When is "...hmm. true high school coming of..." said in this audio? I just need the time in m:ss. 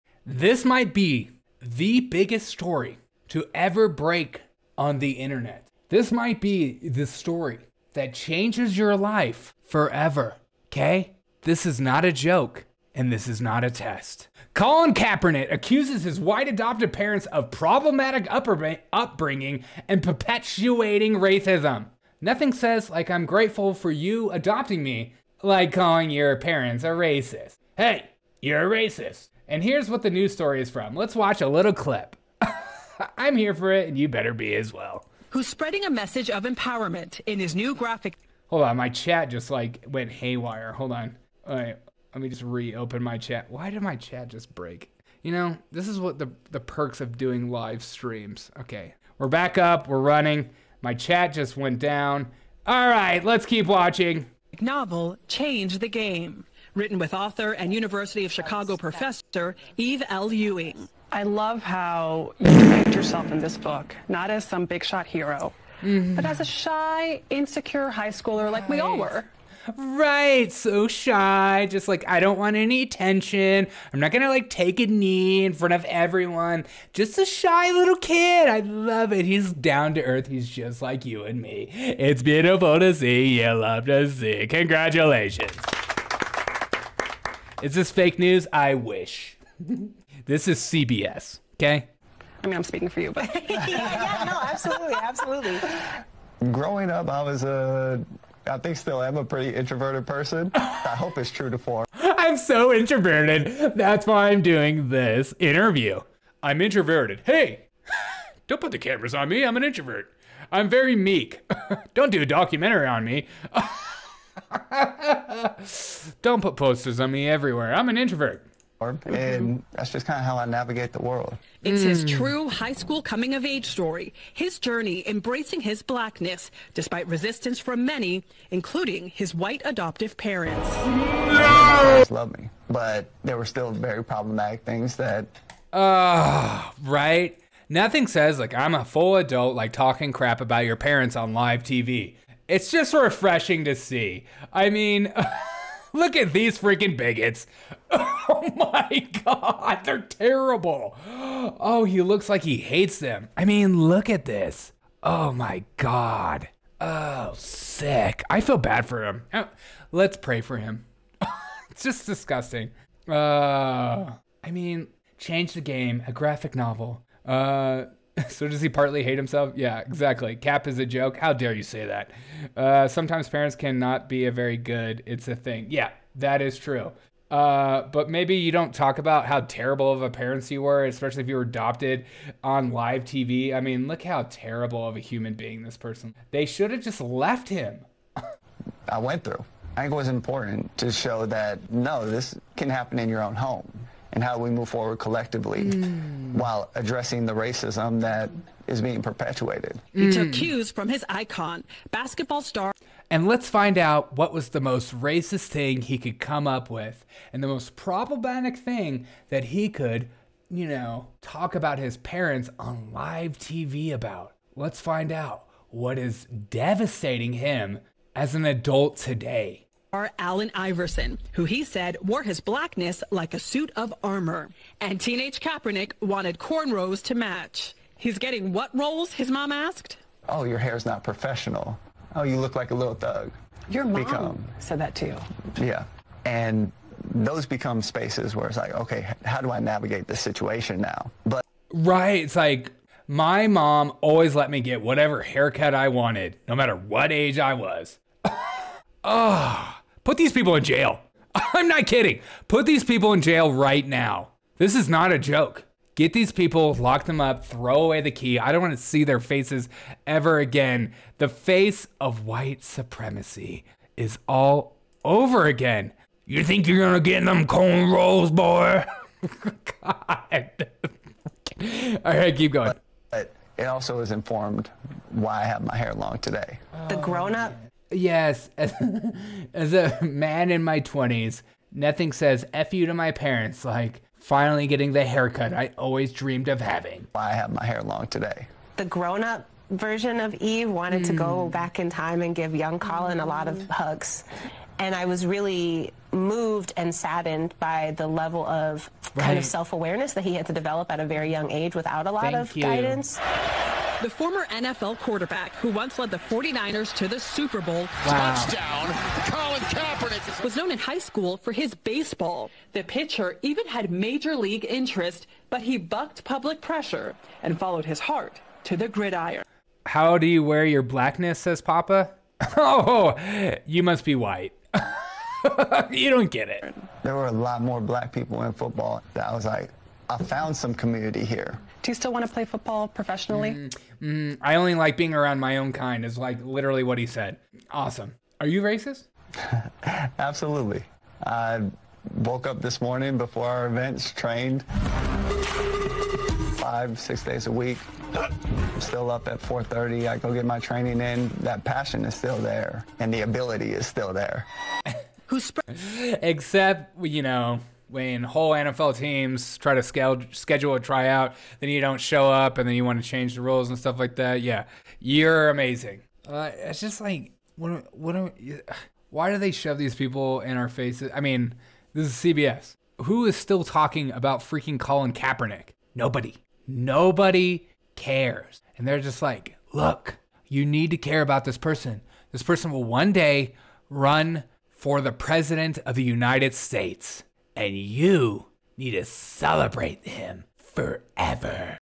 2:02.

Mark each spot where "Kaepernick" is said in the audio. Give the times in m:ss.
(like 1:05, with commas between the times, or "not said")
0:14, 3:45, 5:09, 6:15.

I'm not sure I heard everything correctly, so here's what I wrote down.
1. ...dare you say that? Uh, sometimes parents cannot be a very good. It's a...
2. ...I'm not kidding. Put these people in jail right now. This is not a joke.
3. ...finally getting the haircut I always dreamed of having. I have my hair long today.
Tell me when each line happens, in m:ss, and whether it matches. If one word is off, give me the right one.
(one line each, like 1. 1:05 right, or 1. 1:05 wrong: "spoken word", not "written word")
1. 2:51 right
2. 4:11 right
3. 4:44 right.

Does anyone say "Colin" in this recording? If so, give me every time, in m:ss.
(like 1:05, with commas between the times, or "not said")
0:14, 4:52, 5:09, 6:14.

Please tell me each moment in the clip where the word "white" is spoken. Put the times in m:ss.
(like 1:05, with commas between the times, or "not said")
0:16, 2:09, 4:22, 5:24.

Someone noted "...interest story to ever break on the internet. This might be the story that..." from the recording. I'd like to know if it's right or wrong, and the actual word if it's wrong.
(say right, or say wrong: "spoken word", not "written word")
wrong: "biggest", not "interest".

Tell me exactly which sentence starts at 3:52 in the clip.
Oh, you look like a little thug.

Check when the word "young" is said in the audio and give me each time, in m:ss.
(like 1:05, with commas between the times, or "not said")
4:52, 5:01.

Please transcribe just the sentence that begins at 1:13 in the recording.
I'm not gonna like take a knee in front of everyone.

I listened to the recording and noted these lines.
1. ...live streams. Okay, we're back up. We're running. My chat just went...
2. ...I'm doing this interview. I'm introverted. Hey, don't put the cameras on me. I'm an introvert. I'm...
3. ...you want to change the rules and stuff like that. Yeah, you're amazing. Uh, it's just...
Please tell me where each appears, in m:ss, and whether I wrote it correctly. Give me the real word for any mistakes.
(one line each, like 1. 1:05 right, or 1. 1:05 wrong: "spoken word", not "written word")
1. 0:47 right
2. 1:44 right
3. 6:02 right.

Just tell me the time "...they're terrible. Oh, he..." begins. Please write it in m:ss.
2:29.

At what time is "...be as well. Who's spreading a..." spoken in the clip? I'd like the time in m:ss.
0:34.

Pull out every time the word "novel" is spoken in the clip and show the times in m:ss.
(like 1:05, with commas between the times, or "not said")
0:54, 2:46.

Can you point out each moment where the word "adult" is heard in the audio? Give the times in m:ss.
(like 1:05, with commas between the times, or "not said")
2:19, 3:38.